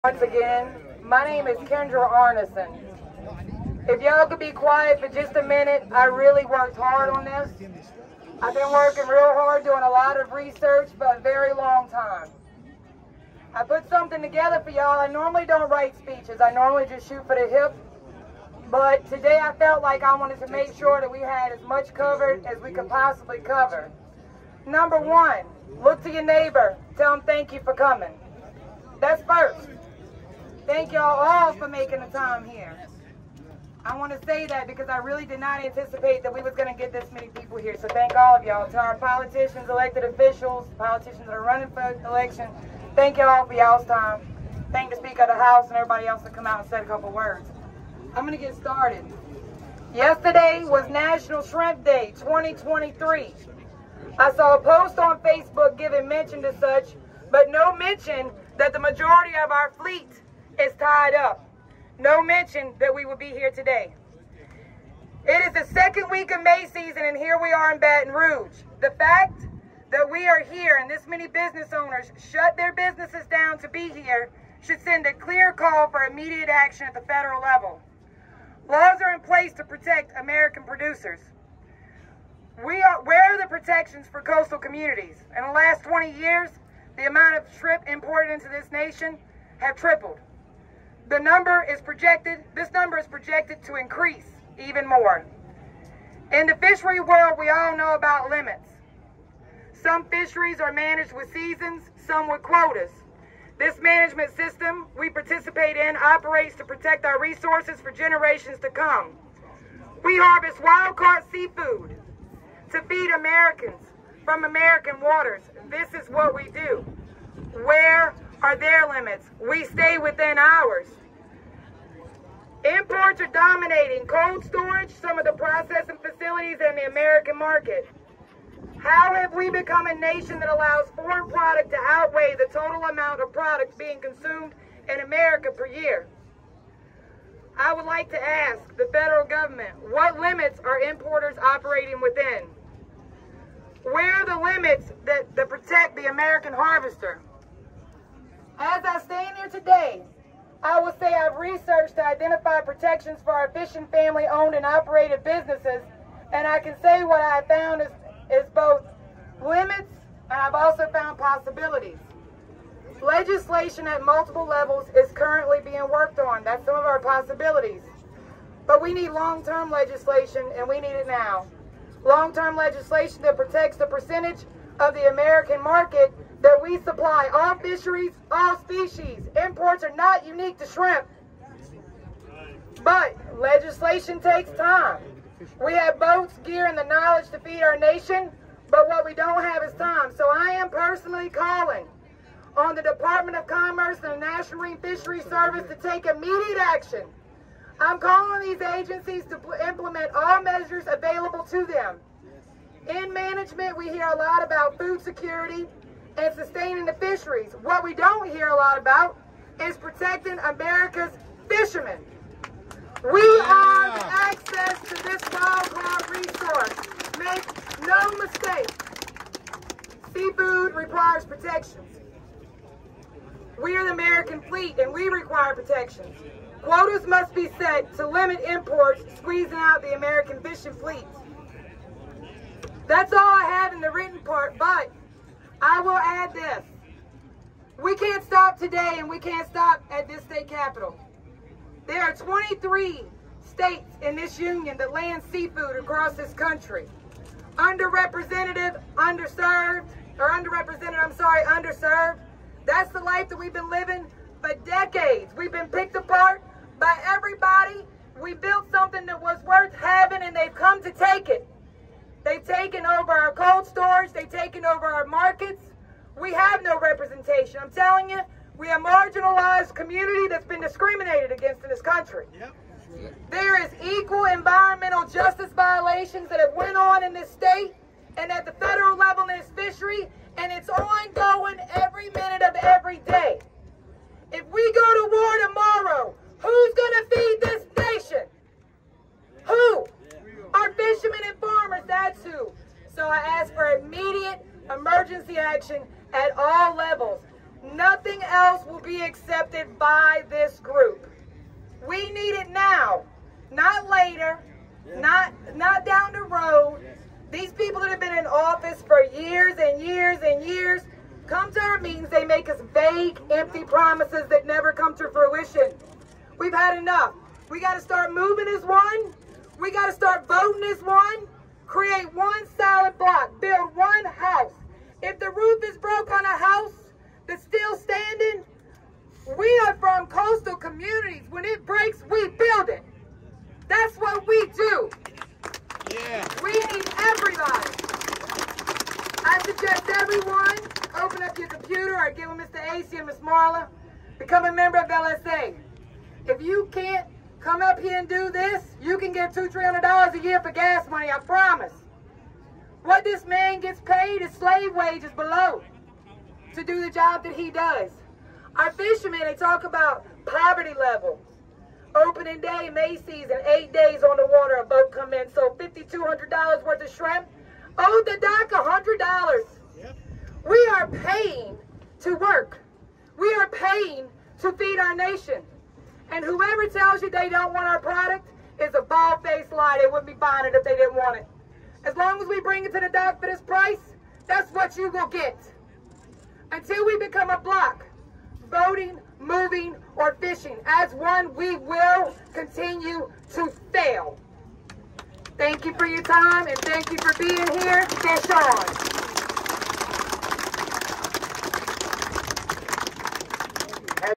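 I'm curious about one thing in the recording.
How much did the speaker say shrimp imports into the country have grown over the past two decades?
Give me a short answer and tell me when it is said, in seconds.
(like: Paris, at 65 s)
tripled, at 89 s.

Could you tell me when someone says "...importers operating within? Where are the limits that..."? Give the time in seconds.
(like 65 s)
140 s.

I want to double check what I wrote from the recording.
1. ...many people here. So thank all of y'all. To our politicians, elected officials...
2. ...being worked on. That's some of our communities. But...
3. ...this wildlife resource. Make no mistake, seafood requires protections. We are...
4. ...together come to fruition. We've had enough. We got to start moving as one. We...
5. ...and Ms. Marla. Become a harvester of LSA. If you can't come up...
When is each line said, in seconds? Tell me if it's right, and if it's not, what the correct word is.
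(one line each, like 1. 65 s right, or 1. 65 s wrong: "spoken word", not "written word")
1. 37 s right
2. 165 s wrong: "possibilities", not "communities"
3. 215 s right
4. 314 s wrong: "never", not "together"
5. 342 s wrong: "member", not "harvester".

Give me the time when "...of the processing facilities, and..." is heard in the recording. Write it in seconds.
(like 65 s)
125 s.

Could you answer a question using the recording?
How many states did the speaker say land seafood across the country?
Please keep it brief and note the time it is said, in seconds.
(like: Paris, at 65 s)
23, at 242 s.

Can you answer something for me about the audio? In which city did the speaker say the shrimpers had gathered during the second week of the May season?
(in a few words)
Baton Rouge.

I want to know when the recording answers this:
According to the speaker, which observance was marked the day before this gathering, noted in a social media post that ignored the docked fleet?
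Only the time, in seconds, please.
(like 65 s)
50 s.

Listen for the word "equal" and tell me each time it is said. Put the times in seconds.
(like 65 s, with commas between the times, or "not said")
273 s.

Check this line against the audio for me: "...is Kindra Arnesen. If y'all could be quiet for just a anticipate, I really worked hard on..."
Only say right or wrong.
wrong.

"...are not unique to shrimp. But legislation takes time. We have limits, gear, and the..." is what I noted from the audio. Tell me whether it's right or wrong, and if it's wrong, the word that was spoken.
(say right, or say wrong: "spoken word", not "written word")
wrong: "boats", not "limits".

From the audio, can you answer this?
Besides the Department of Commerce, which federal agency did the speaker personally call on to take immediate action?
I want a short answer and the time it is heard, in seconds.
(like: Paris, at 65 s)
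National Marine Fisheries Service, at 194 s.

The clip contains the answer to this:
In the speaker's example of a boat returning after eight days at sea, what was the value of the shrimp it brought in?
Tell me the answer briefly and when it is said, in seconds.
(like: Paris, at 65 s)
$5,200, at 365 s.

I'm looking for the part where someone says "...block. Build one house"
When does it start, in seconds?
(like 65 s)
322 s.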